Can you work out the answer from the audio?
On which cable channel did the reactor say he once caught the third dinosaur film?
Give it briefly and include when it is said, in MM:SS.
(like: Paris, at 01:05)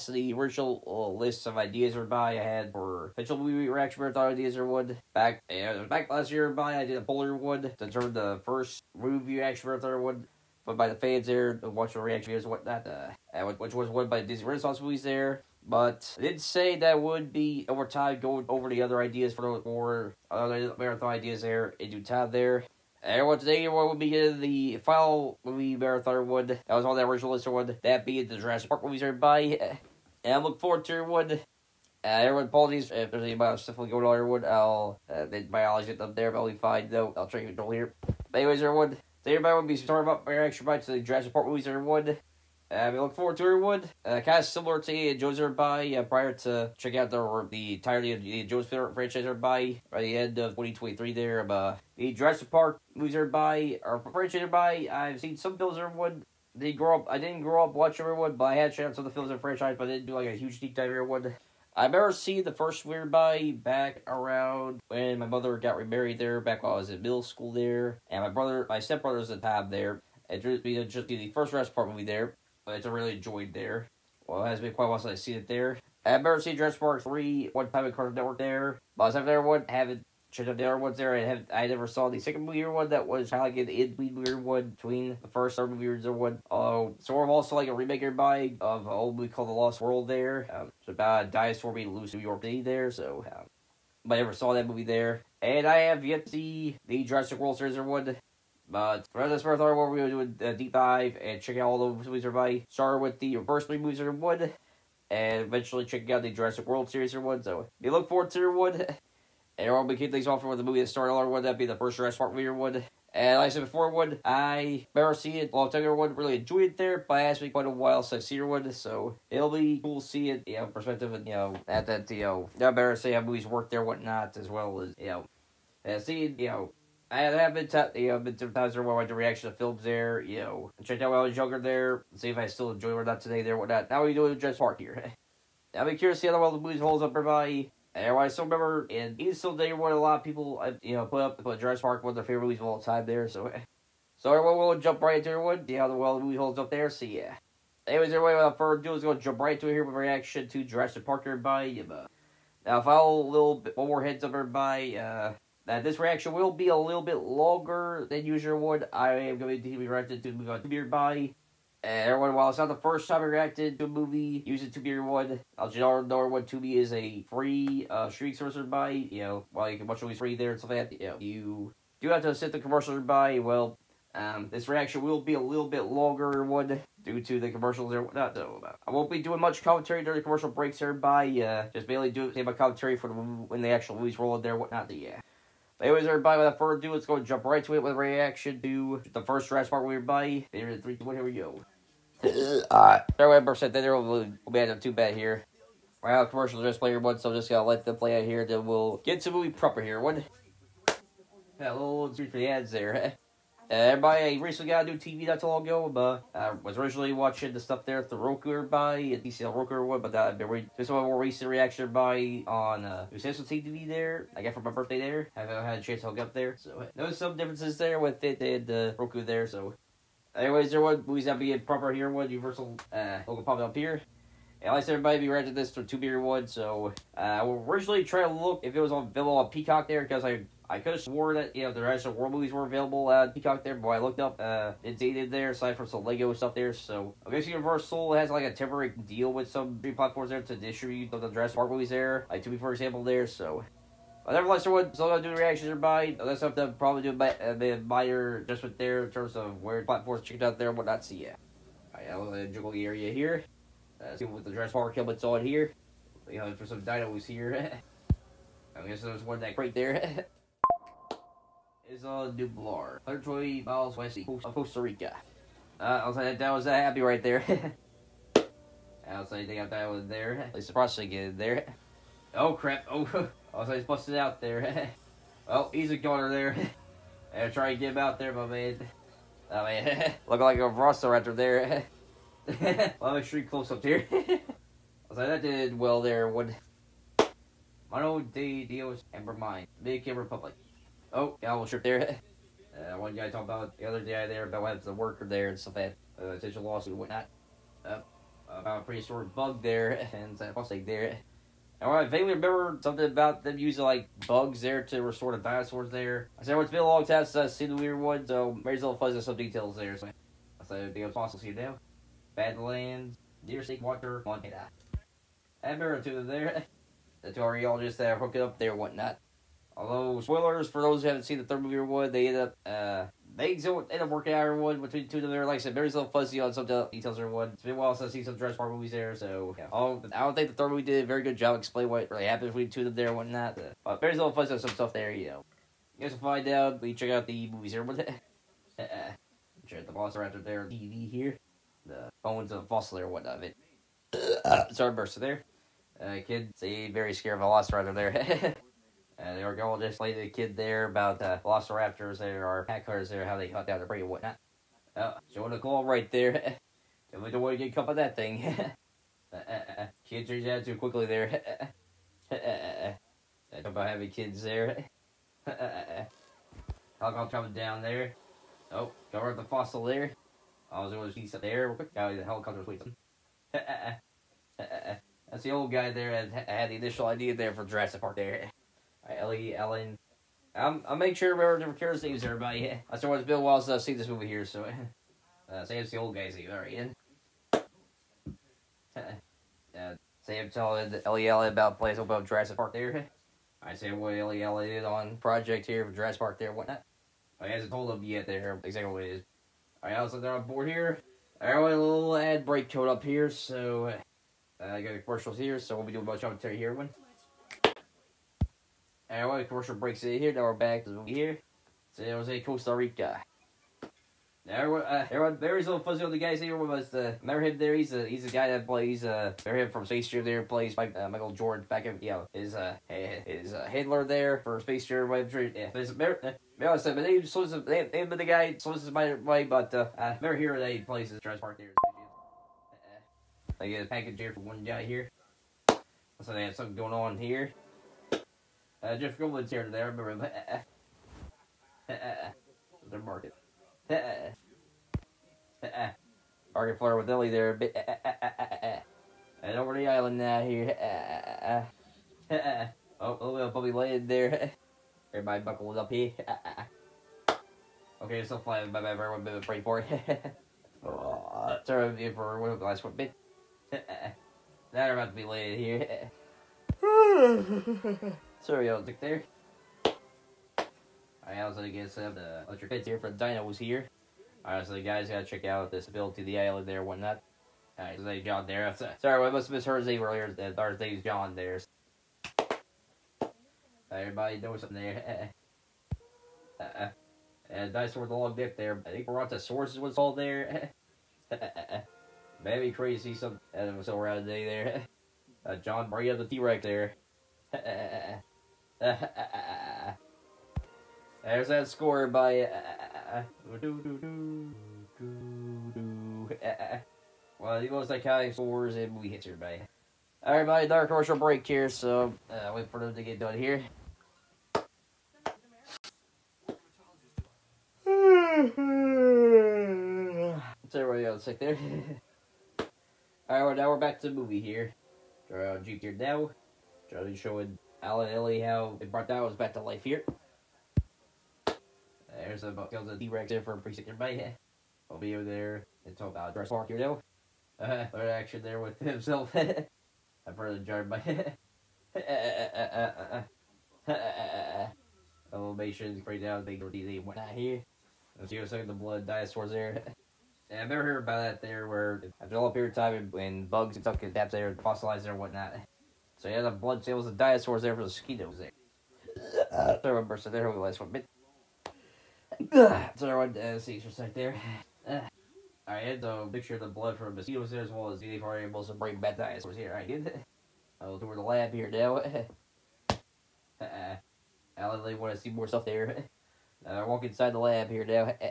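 Cartoon Network, at 01:17.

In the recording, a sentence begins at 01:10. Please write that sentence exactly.
It just be just the first Jurassic Park movie there.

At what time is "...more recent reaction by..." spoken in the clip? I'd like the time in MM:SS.
03:30.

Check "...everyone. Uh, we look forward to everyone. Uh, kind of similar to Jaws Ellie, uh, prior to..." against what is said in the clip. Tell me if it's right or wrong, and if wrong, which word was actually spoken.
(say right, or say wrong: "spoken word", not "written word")
wrong: "Everybody", not "Ellie".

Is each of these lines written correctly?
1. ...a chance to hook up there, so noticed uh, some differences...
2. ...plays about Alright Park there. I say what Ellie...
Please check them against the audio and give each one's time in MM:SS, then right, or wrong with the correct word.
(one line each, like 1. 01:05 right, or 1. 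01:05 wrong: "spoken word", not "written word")
1. 03:35 right
2. 06:31 wrong: "Jurassic", not "Alright".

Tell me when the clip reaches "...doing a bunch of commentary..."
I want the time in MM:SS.
06:45.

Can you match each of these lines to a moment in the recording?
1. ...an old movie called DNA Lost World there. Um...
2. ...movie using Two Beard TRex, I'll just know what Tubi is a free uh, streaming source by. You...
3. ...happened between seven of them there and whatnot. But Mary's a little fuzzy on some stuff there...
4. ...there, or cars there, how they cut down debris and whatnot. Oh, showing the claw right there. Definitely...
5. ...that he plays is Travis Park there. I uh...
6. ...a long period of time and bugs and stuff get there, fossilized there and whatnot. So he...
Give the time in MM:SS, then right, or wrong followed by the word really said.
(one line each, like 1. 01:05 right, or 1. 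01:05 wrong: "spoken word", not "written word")
1. 01:28 wrong: "The", not "DNA"
2. 02:43 wrong: "One", not "TRex"
3. 05:32 wrong: "two", not "seven"
4. 05:52 right
5. 07:10 right
6. 09:12 right.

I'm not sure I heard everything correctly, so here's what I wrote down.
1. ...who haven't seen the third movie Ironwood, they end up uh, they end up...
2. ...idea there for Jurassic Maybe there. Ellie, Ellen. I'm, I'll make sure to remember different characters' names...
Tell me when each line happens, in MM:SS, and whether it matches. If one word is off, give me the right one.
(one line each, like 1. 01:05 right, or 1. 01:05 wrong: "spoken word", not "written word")
1. 05:21 right
2. 06:17 wrong: "Park", not "Maybe".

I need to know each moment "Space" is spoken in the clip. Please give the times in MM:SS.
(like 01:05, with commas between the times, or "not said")
06:59, 07:04.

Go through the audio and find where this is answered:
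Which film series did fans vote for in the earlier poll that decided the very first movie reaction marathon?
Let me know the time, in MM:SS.
00:14.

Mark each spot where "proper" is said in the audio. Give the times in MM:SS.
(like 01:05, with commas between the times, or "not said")
03:19, 03:41.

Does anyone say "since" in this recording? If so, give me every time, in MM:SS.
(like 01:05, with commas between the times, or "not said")
01:14, 01:58, 05:07, 05:27.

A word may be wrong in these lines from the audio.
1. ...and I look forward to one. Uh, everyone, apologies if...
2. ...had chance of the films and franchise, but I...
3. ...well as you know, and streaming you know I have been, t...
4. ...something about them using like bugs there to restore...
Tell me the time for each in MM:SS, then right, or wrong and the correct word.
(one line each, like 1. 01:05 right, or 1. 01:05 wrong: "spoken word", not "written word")
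1. 00:30 right
2. 00:58 right
3. 02:04 wrong: "seeing", not "streaming"
4. 05:02 right.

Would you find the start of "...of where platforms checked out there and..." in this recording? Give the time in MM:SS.
04:09.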